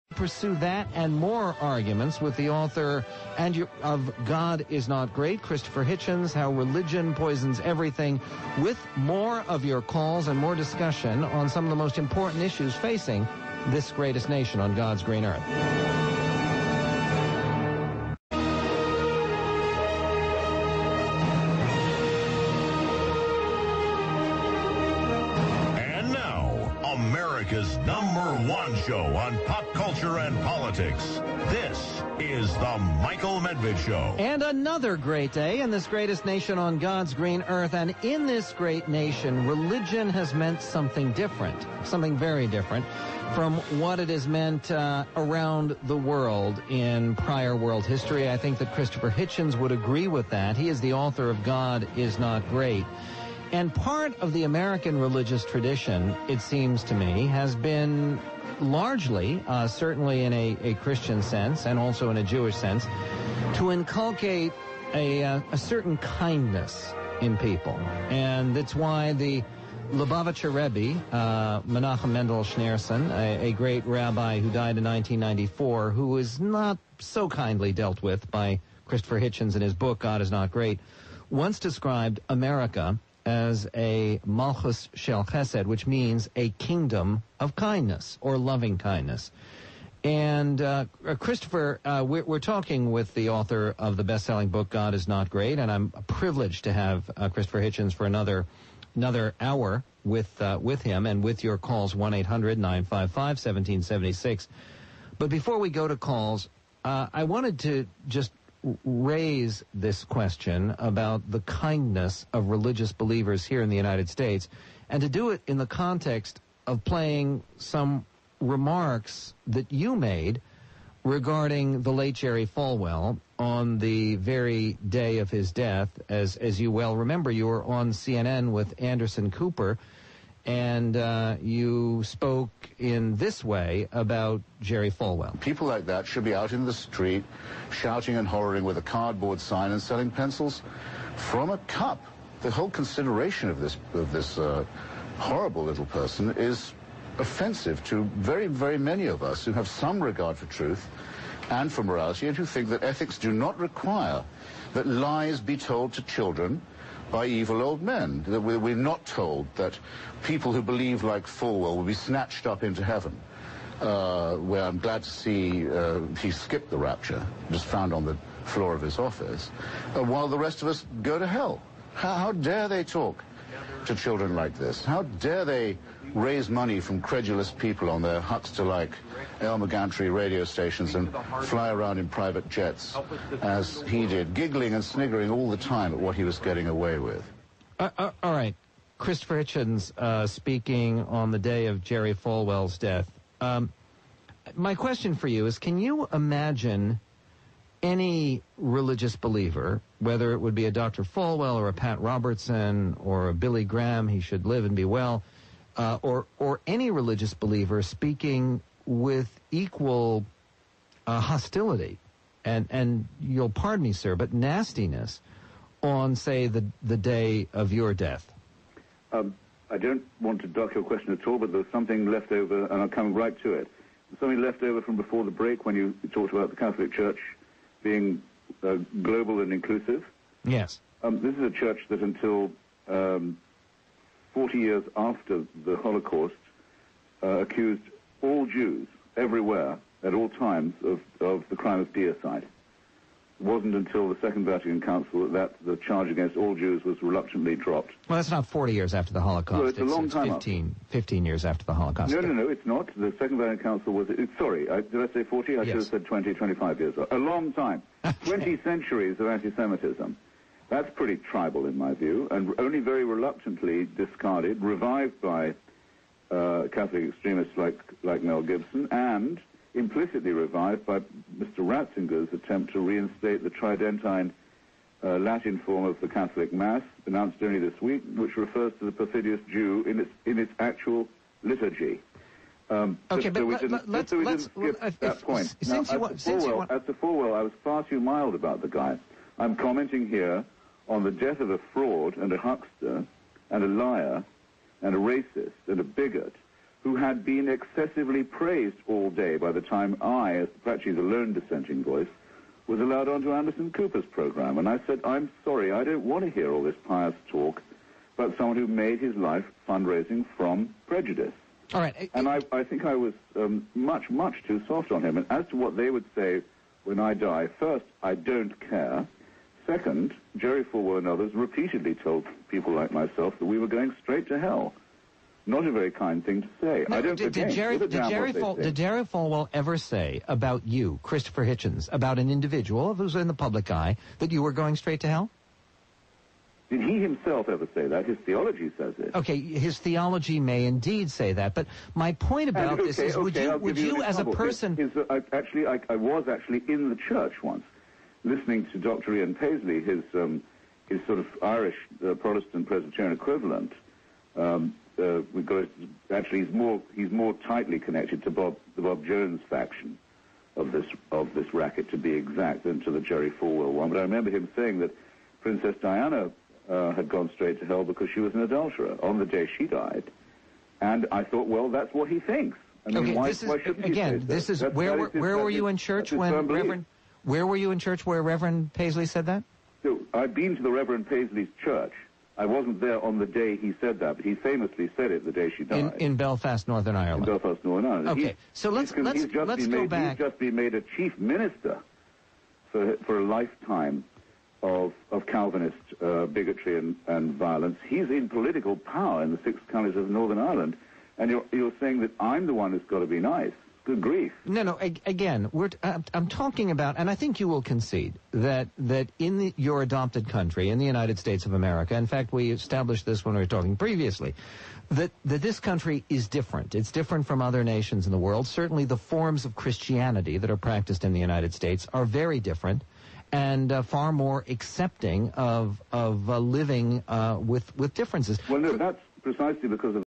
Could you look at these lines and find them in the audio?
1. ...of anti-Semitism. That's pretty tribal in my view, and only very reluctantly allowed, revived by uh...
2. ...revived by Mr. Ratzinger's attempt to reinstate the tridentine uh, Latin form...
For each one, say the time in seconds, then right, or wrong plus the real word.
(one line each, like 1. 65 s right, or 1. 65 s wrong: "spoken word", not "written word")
1. 259 s wrong: "discarded", not "allowed"
2. 270 s right.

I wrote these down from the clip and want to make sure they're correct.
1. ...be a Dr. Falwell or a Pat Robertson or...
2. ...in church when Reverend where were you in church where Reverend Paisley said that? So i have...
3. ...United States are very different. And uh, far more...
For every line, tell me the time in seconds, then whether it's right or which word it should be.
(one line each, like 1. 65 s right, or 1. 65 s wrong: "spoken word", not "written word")
1. 200 s right
2. 375 s right
3. 421 s right.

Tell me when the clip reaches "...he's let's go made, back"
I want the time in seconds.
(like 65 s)
389 s.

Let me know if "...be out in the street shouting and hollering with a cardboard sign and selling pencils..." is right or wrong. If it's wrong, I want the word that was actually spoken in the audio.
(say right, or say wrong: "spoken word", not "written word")
right.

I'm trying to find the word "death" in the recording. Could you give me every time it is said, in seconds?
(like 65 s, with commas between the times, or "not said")
125 s, 192 s, 217 s, 291 s.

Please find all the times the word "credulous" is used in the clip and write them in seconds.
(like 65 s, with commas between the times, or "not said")
177 s.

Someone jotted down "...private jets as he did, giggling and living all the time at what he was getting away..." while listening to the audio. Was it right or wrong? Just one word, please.
wrong.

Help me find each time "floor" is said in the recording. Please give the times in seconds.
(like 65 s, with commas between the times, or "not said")
168 s.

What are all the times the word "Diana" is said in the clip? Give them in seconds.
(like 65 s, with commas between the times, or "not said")
365 s.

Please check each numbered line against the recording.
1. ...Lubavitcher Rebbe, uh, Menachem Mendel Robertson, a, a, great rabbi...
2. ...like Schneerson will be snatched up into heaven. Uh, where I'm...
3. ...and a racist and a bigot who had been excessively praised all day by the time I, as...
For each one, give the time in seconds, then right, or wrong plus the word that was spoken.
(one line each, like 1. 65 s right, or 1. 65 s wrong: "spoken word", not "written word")
1. 69 s wrong: "Schneerson", not "Robertson"
2. 161 s wrong: "Falwell", not "Schneerson"
3. 294 s right.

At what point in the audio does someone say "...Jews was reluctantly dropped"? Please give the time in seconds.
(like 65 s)
246 s.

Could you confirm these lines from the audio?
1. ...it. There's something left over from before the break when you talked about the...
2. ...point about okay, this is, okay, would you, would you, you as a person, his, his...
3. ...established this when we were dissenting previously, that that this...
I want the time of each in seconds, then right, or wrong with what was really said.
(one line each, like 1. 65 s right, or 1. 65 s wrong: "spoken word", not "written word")
1. 223 s right
2. 342 s right
3. 412 s wrong: "talking", not "dissenting".